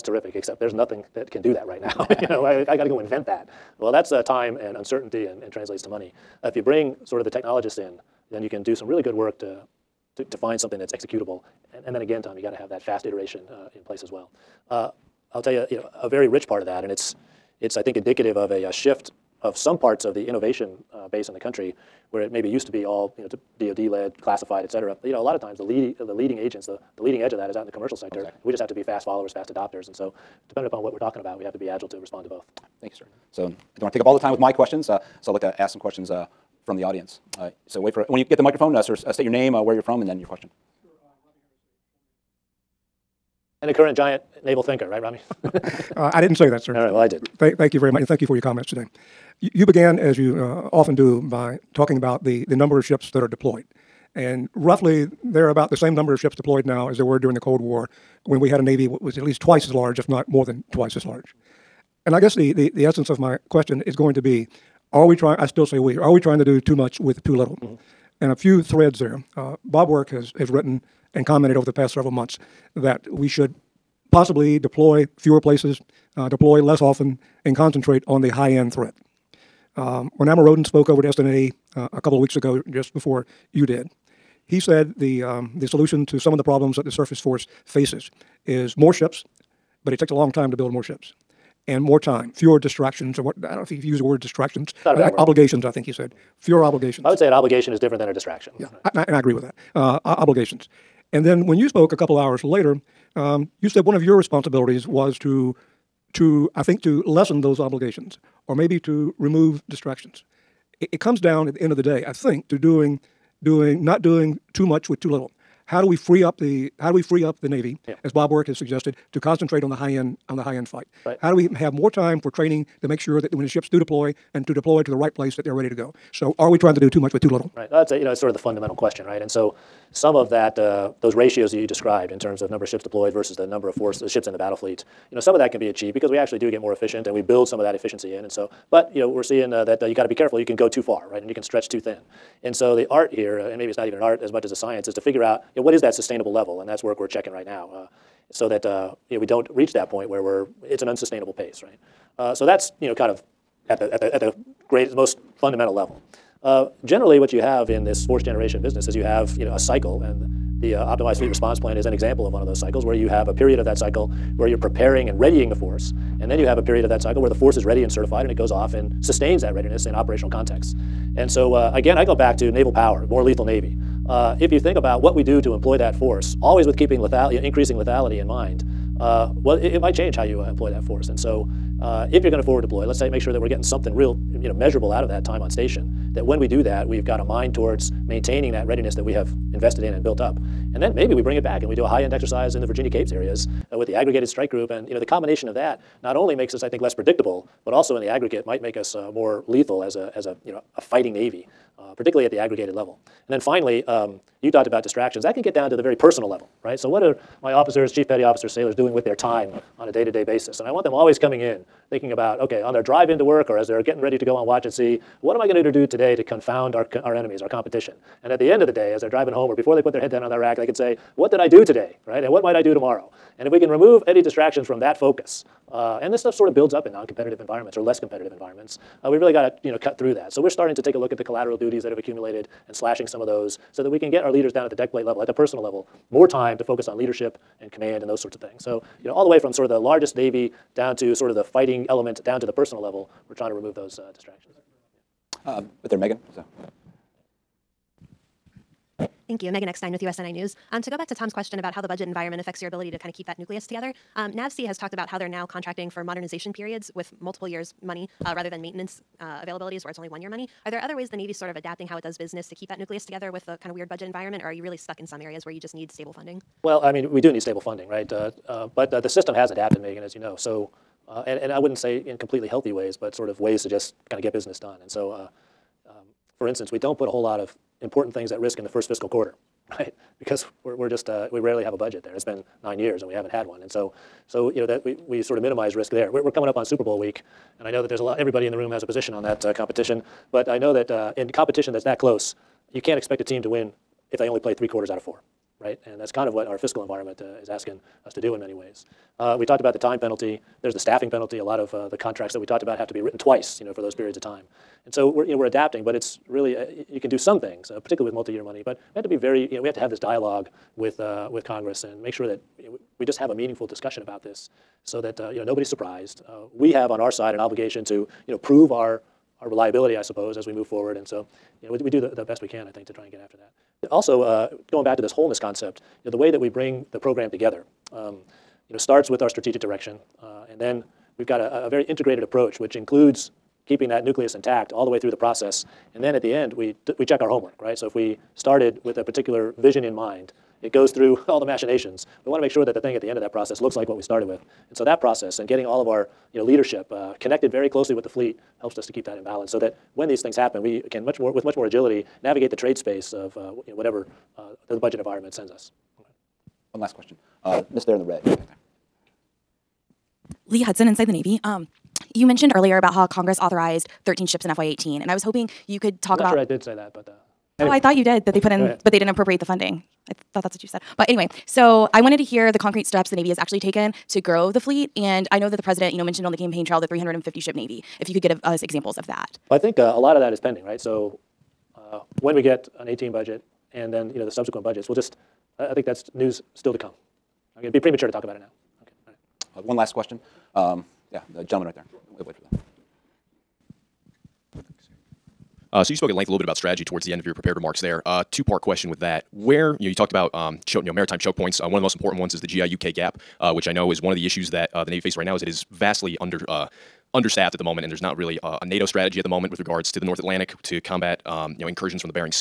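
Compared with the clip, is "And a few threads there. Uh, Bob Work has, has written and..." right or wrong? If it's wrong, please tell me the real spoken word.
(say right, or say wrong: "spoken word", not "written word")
right.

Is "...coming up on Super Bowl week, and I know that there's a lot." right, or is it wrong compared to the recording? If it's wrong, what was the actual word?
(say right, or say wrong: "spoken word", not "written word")
right.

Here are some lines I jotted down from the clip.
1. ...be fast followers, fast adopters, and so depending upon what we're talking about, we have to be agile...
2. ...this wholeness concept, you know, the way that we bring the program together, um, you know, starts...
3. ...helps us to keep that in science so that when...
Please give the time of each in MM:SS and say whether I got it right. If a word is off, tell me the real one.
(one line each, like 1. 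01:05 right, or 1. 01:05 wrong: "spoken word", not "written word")
1. 00:28 right
2. 05:25 right
3. 05:48 wrong: "balance", not "science".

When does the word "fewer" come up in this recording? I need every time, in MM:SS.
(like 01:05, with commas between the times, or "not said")
01:15, 01:32, 01:36.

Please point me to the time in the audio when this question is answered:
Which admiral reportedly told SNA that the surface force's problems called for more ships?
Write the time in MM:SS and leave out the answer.
01:20.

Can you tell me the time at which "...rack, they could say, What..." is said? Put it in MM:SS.
03:40.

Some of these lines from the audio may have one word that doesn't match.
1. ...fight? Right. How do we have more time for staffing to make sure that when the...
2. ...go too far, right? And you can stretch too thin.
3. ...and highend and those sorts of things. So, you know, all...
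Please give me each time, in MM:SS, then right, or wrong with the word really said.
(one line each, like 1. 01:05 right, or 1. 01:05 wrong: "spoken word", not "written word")
1. 02:00 wrong: "training", not "staffing"
2. 02:20 right
3. 03:57 wrong: "command", not "highend".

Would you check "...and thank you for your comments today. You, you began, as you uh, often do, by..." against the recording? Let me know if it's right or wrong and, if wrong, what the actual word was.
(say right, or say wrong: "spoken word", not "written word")
right.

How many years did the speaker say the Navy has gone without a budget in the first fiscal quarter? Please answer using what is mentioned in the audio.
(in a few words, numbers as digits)
9.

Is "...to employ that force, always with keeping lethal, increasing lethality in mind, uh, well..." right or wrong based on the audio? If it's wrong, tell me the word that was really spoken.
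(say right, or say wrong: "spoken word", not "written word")
right.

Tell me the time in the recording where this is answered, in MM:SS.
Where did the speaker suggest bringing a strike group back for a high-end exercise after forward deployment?
03:12.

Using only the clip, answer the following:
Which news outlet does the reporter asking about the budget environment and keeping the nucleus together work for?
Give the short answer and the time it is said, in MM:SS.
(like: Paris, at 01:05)
USNI News, at 04:10.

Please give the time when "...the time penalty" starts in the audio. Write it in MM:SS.
04:59.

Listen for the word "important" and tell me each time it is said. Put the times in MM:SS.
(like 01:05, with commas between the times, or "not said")
04:37, 06:41.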